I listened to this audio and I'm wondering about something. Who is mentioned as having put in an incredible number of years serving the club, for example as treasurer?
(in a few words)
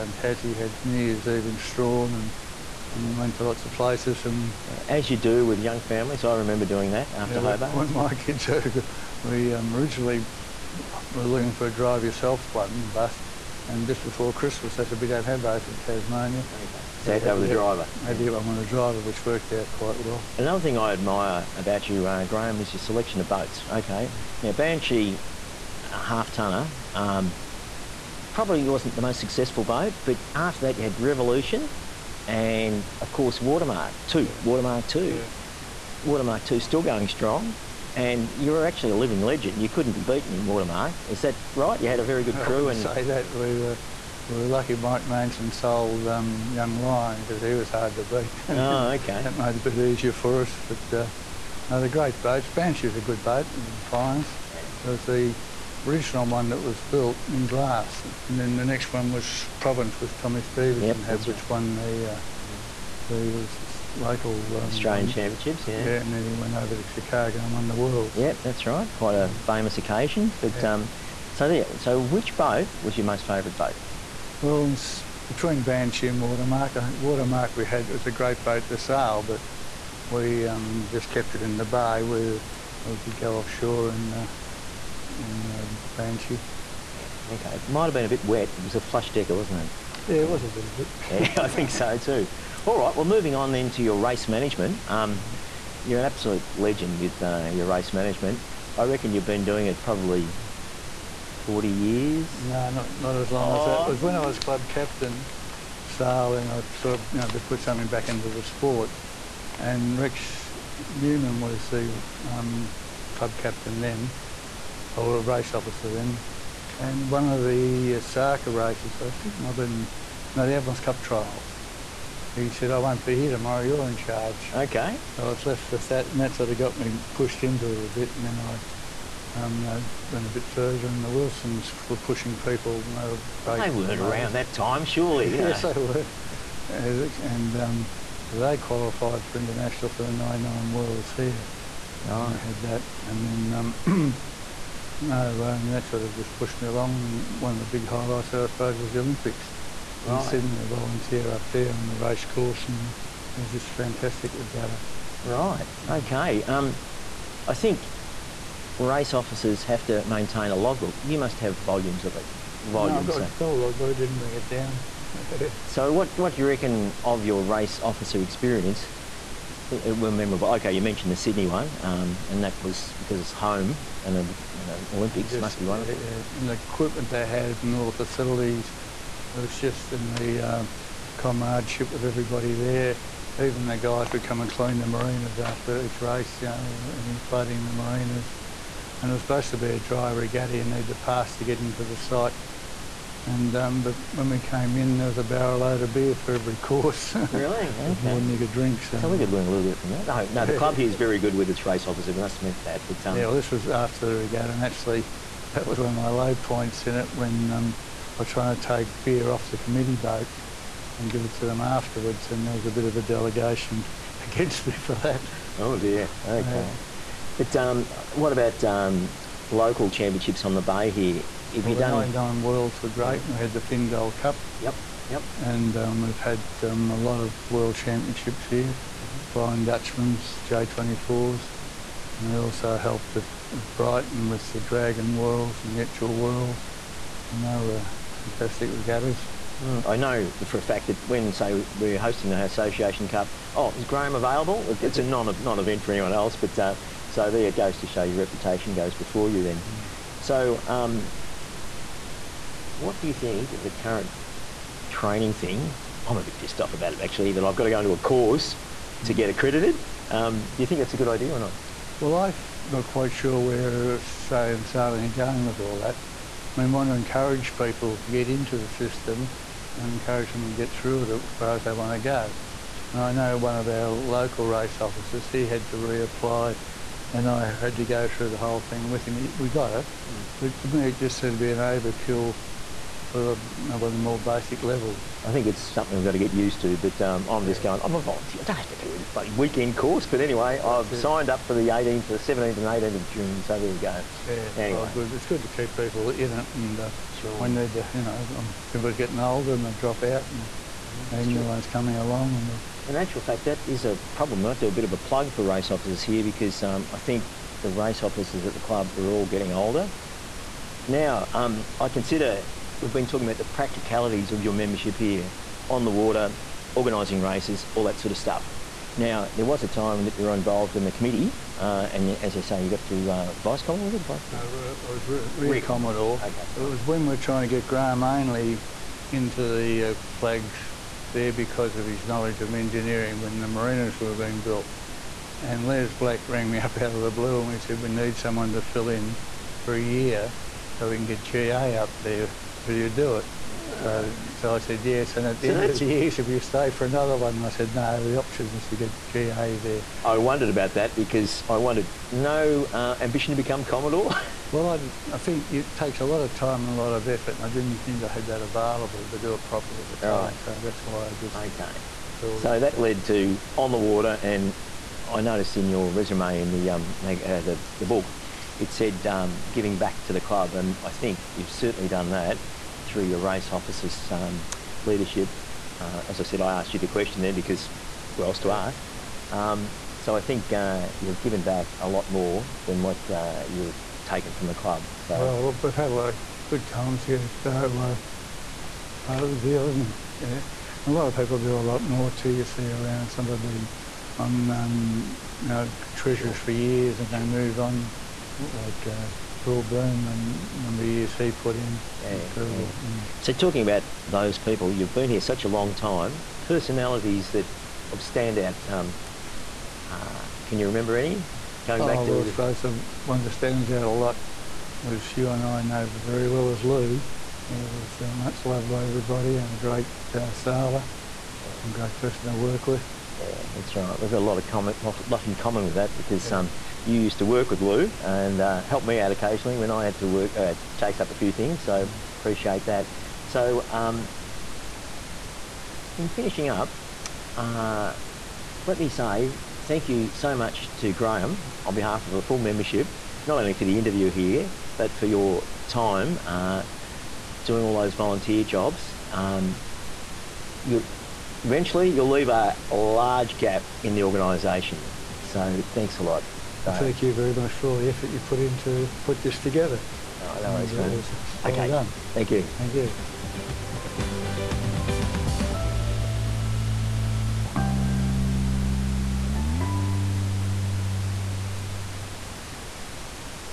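Phil Byrne.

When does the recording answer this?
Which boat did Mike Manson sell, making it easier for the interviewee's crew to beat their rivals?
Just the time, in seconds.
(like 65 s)
46 s.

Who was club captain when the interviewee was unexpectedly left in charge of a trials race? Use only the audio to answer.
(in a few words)
Rex Newman.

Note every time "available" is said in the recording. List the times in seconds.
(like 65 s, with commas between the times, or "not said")
244 s, 358 s.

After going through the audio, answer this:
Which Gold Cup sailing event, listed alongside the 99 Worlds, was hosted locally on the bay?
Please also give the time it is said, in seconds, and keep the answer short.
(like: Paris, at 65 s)
Finn Gold Cup, at 223 s.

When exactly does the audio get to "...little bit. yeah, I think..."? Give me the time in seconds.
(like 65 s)
90 s.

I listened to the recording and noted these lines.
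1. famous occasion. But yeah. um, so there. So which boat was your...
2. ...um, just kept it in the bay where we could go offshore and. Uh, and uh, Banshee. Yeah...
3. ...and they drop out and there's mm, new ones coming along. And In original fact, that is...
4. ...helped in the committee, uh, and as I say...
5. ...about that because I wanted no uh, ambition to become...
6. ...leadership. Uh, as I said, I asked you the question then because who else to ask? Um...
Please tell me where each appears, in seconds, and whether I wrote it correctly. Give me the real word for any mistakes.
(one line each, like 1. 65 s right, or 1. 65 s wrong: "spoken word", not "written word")
1. 69 s right
2. 80 s right
3. 299 s wrong: "actual", not "original"
4. 320 s wrong: "involved", not "helped"
5. 350 s right
6. 374 s right.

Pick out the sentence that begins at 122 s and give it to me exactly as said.
He said, I won't be here tomorrow, you're in charge.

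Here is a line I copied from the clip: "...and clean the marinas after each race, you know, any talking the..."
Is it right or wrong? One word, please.
wrong.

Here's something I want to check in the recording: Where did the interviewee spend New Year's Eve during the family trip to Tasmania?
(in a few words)
Strahan.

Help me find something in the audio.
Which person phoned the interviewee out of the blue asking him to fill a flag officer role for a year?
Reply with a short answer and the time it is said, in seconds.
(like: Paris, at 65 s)
Les Black, at 335 s.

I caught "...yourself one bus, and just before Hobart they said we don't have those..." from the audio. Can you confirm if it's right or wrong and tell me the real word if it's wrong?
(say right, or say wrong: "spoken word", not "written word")
wrong: "Christmas", not "Hobart".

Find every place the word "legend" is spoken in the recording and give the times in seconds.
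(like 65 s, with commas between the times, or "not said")
39 s, 96 s.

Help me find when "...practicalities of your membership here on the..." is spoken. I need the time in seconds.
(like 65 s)
313 s.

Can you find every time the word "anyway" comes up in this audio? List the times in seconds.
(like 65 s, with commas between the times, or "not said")
290 s, 294 s.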